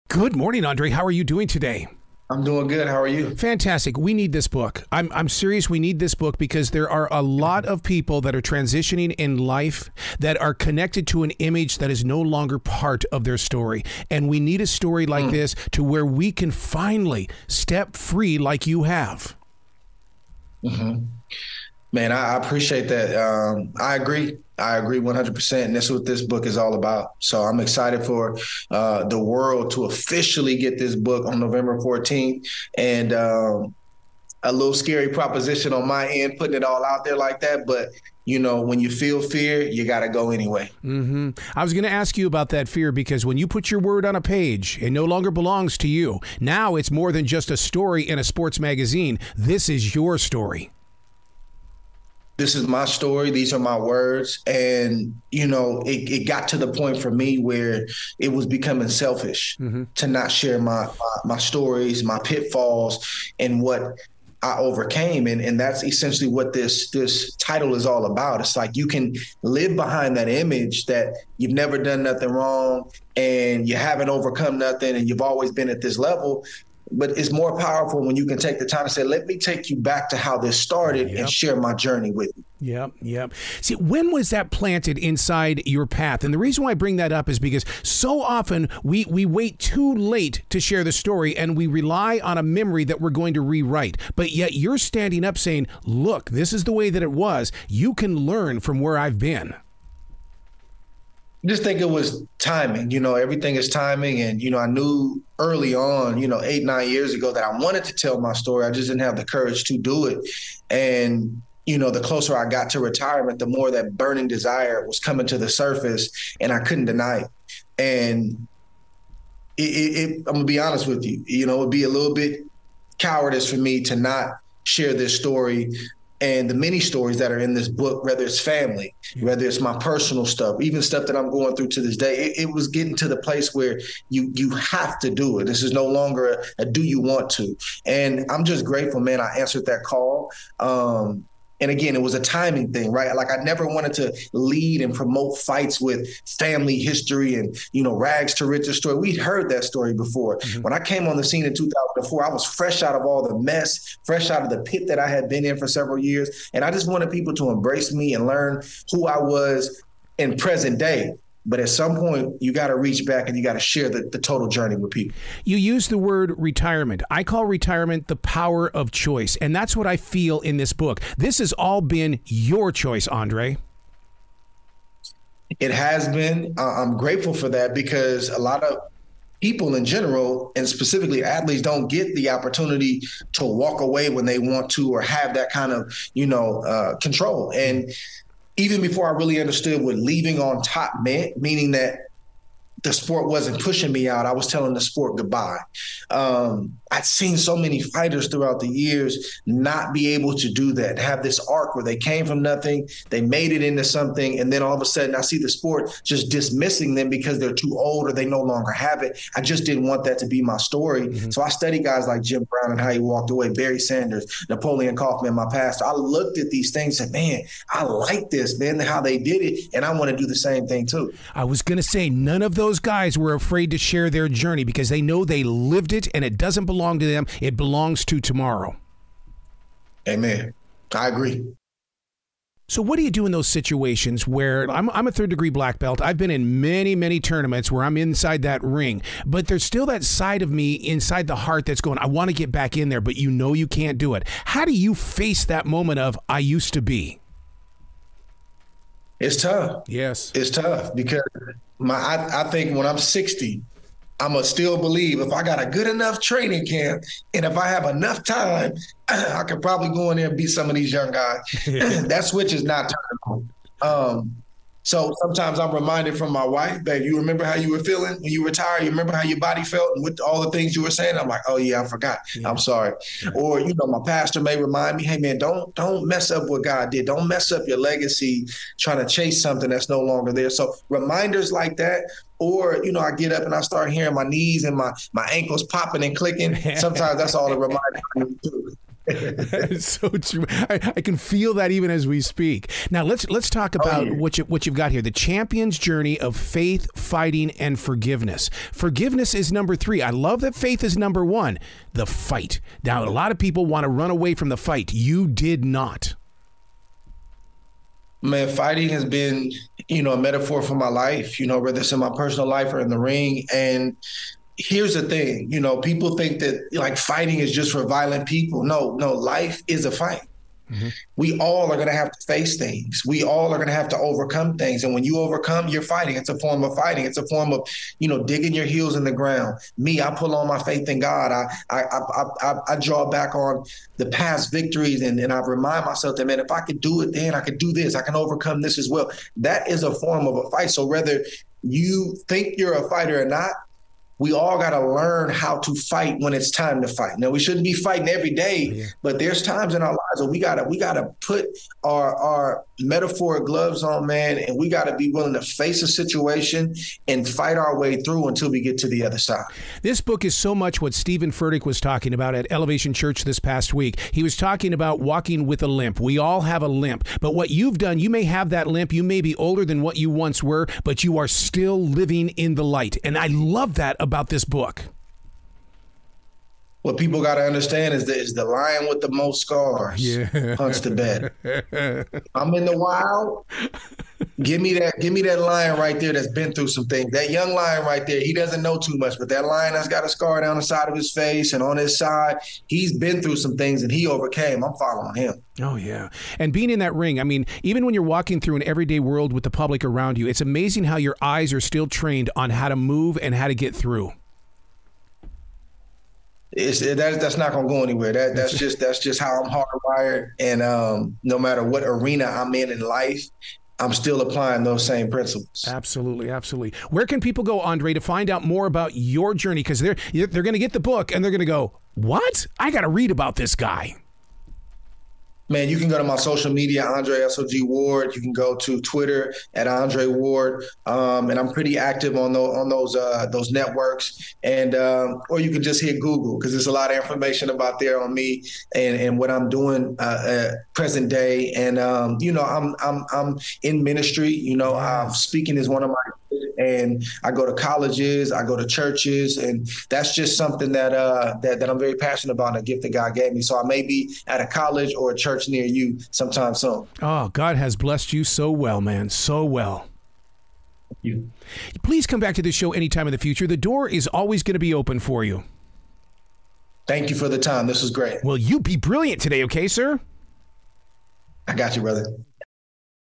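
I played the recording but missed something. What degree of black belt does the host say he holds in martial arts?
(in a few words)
Third degree.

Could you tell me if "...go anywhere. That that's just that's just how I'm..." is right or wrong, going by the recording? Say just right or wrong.
right.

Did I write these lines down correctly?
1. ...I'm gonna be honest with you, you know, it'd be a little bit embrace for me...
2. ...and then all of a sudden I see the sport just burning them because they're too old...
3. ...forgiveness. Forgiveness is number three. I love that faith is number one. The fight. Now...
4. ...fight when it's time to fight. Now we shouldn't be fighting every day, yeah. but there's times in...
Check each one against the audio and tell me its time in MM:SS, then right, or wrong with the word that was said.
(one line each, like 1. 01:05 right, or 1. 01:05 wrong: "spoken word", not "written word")
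1. 02:00 wrong: "cowardice", not "embrace"
2. 03:24 wrong: "dismissing", not "burning"
3. 04:57 right
4. 05:45 right.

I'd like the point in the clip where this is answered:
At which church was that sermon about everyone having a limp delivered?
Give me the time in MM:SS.
06:02.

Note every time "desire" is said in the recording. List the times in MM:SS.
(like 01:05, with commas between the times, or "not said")
01:54.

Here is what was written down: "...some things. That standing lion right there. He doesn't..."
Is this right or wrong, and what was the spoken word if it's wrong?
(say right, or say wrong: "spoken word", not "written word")
wrong: "young", not "standing".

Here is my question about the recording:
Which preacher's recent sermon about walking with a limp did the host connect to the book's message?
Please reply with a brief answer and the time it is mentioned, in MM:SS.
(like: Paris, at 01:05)
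Steven Furtick, at 06:00.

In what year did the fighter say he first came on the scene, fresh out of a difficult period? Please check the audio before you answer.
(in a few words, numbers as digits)
2004.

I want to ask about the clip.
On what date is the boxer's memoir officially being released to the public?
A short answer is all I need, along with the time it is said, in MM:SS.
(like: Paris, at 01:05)
November 14th, at 00:31.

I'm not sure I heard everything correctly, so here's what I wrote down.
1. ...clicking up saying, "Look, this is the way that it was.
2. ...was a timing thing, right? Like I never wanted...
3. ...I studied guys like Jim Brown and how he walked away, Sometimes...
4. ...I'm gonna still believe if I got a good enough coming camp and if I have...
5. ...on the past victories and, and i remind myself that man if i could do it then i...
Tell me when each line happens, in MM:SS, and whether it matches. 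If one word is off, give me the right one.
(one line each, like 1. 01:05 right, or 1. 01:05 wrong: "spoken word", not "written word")
1. 01:34 wrong: "standing", not "clicking"
2. 02:22 right
3. 03:31 wrong: "Barry", not "Sometimes"
4. 04:14 wrong: "training", not "coming"
5. 05:33 right.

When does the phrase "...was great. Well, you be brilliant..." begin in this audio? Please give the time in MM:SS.
07:47.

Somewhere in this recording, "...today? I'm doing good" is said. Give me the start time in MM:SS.
00:01.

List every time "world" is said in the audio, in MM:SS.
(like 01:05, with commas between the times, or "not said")
00:29, 06:38.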